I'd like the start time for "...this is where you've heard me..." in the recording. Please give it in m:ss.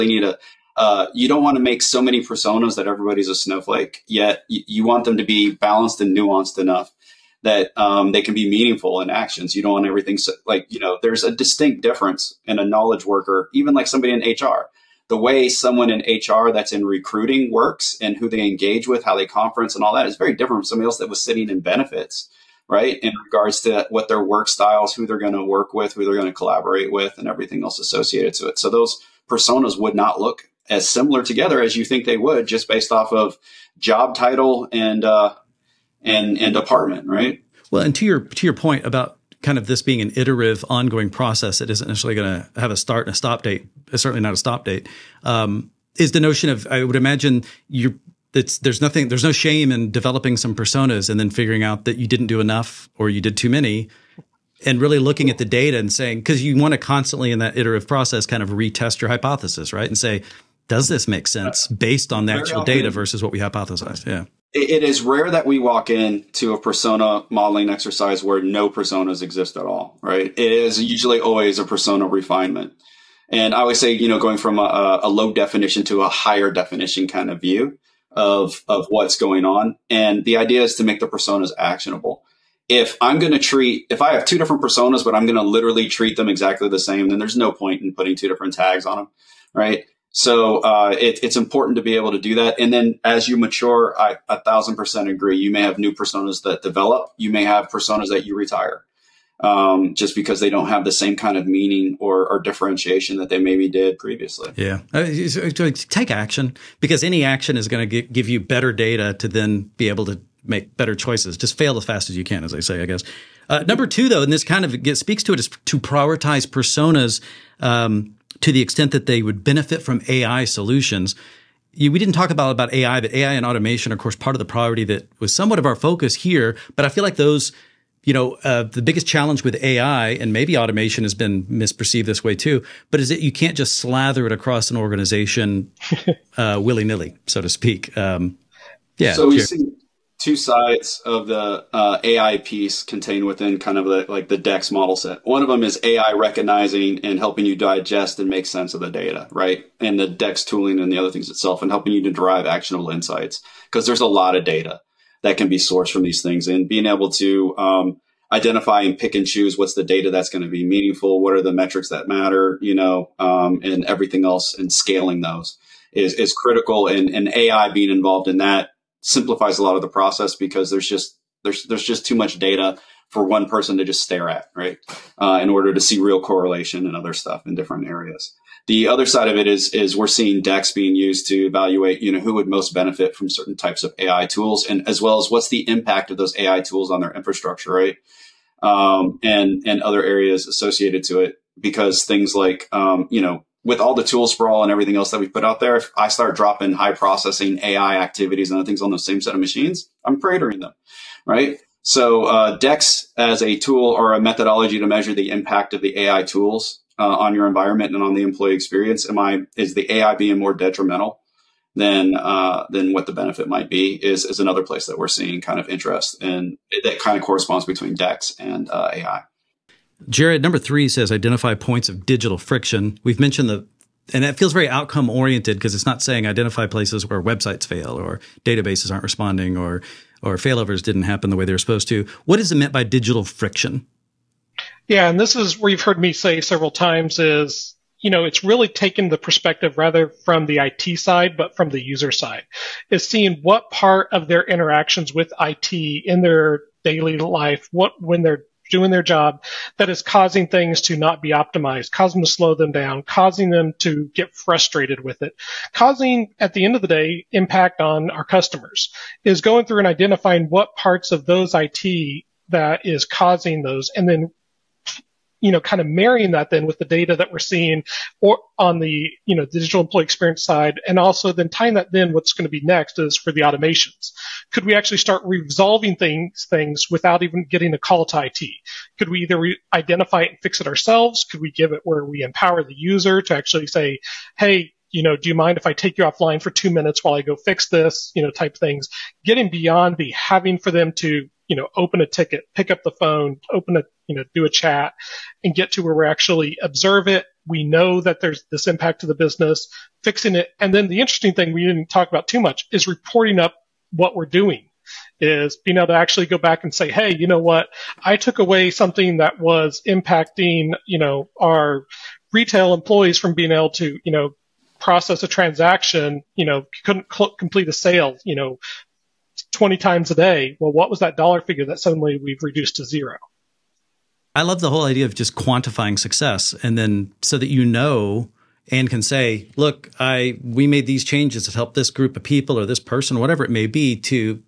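3:55.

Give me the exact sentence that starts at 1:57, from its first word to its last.
Um, to the extent that they would benefit from AI solutions.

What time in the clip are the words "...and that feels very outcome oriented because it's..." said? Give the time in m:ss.
3:44.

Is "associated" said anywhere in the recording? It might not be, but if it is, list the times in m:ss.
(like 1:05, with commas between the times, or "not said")
0:27, 3:10.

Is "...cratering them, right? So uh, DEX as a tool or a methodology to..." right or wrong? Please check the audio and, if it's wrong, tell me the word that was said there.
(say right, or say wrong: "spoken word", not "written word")
right.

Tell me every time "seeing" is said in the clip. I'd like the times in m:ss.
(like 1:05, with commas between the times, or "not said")
3:00, 3:35, 4:03, 4:27.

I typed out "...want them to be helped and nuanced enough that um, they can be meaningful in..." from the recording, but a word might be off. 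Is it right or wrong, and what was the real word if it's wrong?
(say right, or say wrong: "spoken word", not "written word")
wrong: "balanced", not "helped".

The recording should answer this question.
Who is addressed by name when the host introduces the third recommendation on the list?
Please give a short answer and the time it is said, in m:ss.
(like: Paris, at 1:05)
Jared, at 3:40.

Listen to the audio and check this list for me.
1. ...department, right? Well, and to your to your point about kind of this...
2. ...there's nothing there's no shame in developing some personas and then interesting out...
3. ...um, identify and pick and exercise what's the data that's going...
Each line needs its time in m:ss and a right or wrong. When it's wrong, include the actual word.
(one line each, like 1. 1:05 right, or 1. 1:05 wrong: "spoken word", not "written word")
1. 0:36 right
2. 0:48 wrong: "figuring", not "interesting"
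3. 2:37 wrong: "choose", not "exercise".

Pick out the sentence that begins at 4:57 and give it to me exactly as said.
We know that there's this impact to the business, fixing it.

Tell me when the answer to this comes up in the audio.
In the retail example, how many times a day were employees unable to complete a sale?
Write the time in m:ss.
5:19.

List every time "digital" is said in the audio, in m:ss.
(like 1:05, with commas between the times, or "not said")
3:42, 3:52, 4:29.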